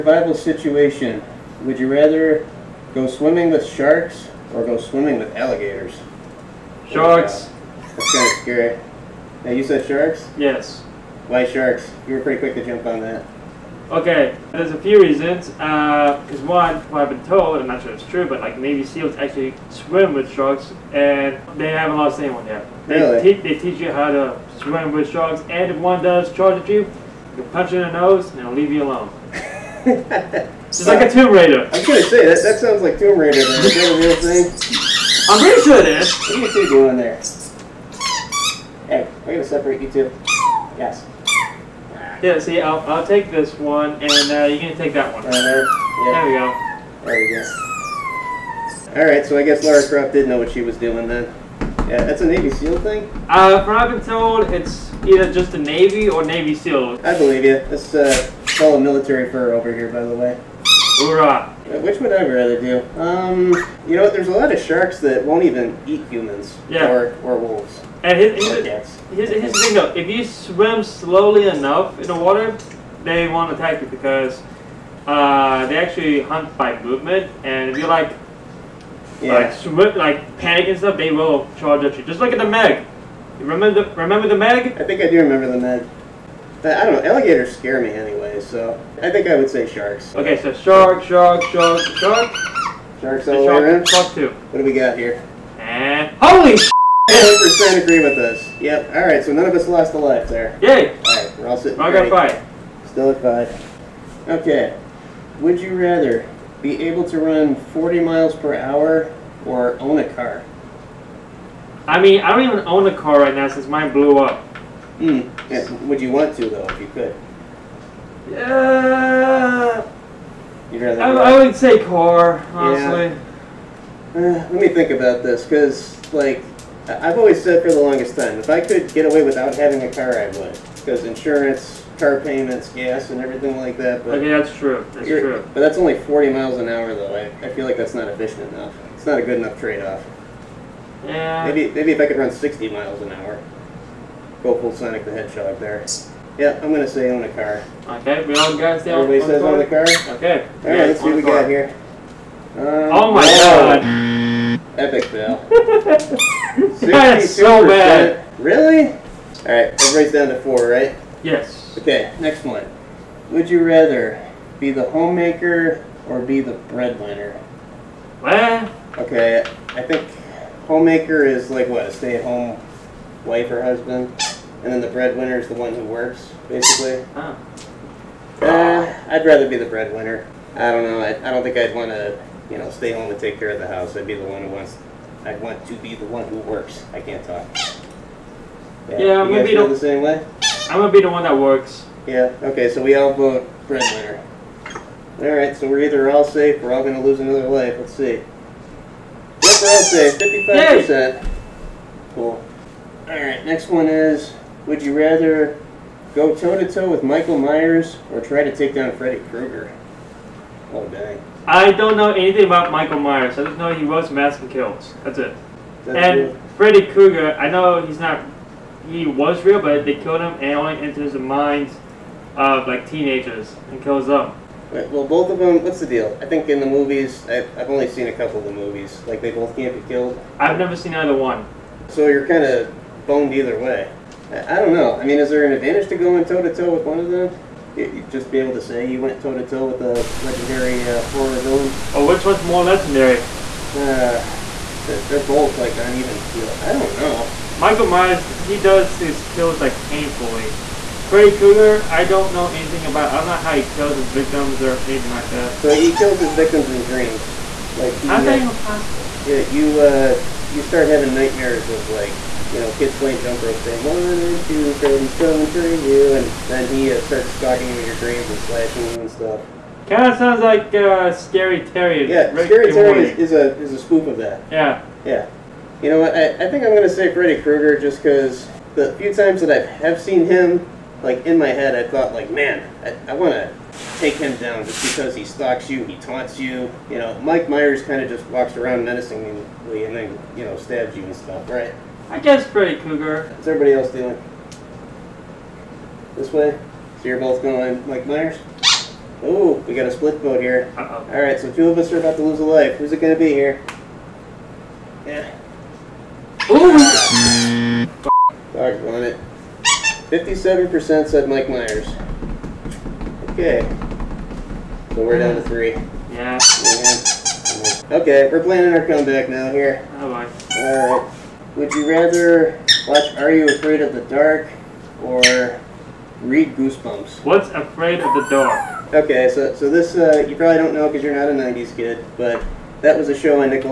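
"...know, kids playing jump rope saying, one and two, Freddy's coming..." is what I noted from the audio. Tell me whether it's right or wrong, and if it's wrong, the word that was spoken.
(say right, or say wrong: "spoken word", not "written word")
right.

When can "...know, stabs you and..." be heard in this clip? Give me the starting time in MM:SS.
04:50.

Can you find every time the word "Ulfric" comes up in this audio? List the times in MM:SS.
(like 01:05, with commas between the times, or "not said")
not said.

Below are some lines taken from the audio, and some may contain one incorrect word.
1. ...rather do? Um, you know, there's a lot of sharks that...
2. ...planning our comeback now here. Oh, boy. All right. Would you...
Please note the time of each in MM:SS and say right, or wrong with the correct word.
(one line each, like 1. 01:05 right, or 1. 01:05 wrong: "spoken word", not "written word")
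1. 01:02 right
2. 05:18 right.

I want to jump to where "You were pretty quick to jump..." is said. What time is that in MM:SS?
00:12.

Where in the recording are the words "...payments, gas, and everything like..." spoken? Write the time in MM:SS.
02:12.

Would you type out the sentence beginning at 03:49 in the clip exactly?
Like, they both can't be killed.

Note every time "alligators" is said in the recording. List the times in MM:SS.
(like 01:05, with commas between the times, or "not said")
00:05, 01:27.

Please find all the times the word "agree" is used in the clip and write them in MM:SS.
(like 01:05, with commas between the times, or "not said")
01:37.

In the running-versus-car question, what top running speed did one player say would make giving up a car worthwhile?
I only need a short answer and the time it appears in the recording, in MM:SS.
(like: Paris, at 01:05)
60 miles an hour, at 02:22.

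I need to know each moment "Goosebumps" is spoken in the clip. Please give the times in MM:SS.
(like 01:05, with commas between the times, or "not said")
05:26.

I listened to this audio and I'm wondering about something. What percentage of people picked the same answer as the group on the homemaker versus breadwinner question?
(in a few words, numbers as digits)
55%.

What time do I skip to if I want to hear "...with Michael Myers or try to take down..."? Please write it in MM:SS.
03:26.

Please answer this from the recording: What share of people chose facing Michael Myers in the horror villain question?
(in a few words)
57%.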